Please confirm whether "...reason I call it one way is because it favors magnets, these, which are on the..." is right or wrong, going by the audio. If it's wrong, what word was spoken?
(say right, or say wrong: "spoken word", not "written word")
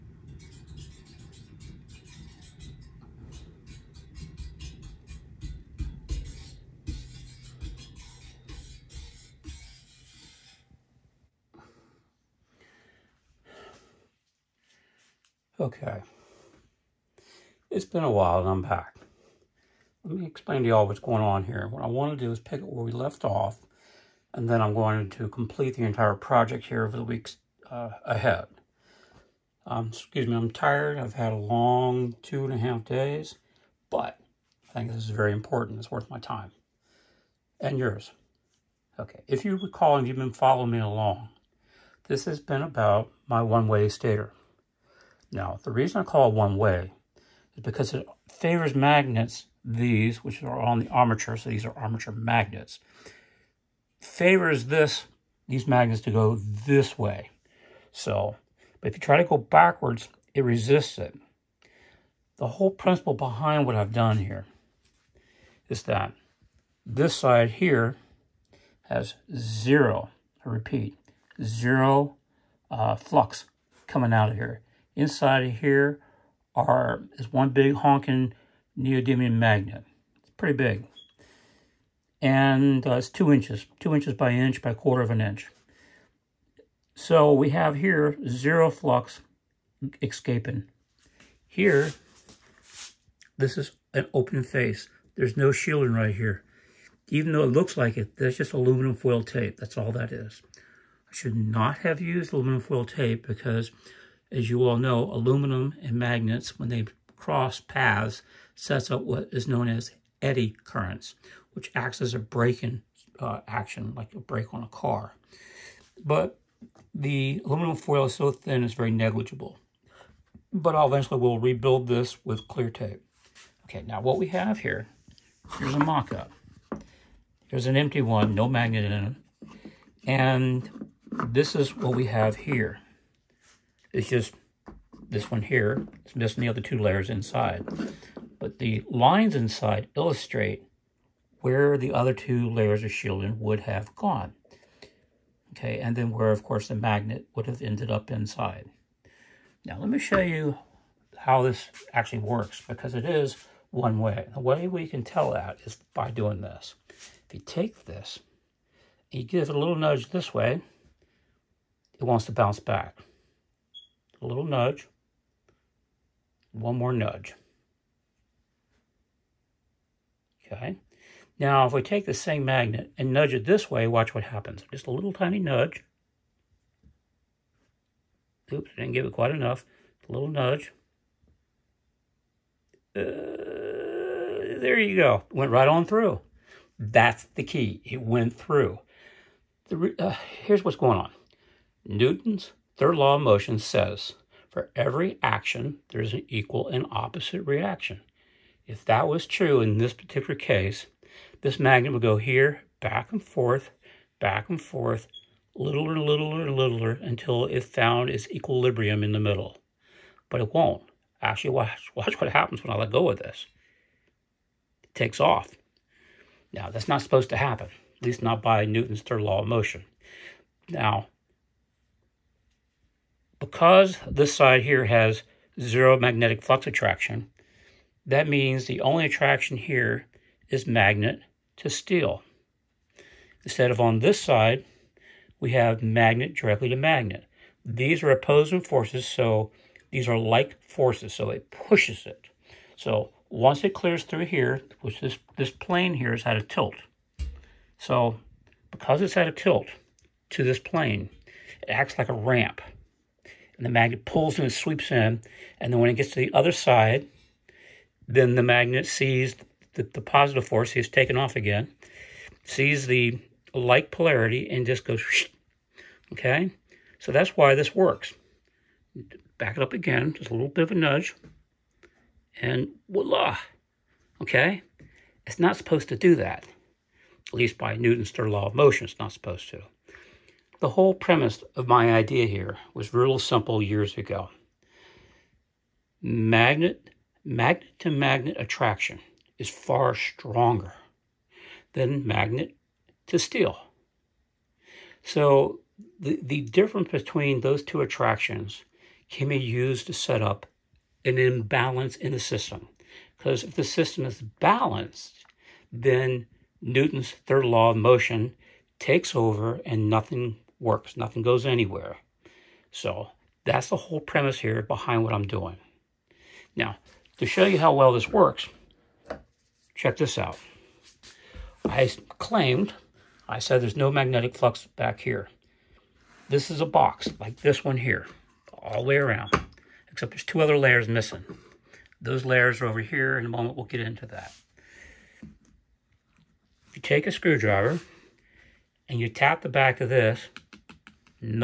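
right.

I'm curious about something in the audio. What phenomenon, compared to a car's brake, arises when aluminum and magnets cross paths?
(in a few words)
Eddy currents.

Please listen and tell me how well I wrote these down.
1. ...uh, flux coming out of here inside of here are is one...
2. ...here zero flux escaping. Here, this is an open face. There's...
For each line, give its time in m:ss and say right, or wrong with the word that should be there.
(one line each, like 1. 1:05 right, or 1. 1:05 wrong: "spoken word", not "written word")
1. 1:12 right
2. 1:27 right.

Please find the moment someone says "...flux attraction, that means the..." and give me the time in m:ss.
3:46.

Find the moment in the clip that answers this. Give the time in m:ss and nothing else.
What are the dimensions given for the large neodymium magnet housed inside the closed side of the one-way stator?
1:23.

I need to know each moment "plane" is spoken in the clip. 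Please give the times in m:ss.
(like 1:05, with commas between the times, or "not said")
4:05, 4:10.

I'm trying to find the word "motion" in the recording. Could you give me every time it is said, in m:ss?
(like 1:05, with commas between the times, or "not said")
3:13, 3:39, 4:38, 5:07.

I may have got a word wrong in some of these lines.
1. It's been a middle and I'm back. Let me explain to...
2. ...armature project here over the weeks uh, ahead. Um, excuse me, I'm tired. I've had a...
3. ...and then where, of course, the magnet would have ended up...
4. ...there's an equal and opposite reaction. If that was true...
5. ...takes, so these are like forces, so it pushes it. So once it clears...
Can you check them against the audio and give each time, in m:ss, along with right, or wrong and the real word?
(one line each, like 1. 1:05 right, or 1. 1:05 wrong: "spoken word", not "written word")
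1. 0:17 wrong: "while", not "middle"
2. 0:25 wrong: "entire", not "armature"
3. 2:25 right
4. 3:15 right
5. 3:58 wrong: "forces", not "takes".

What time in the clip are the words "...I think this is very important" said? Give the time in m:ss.
0:34.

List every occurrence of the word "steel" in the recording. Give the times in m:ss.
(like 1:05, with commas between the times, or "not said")
3:51, 4:53.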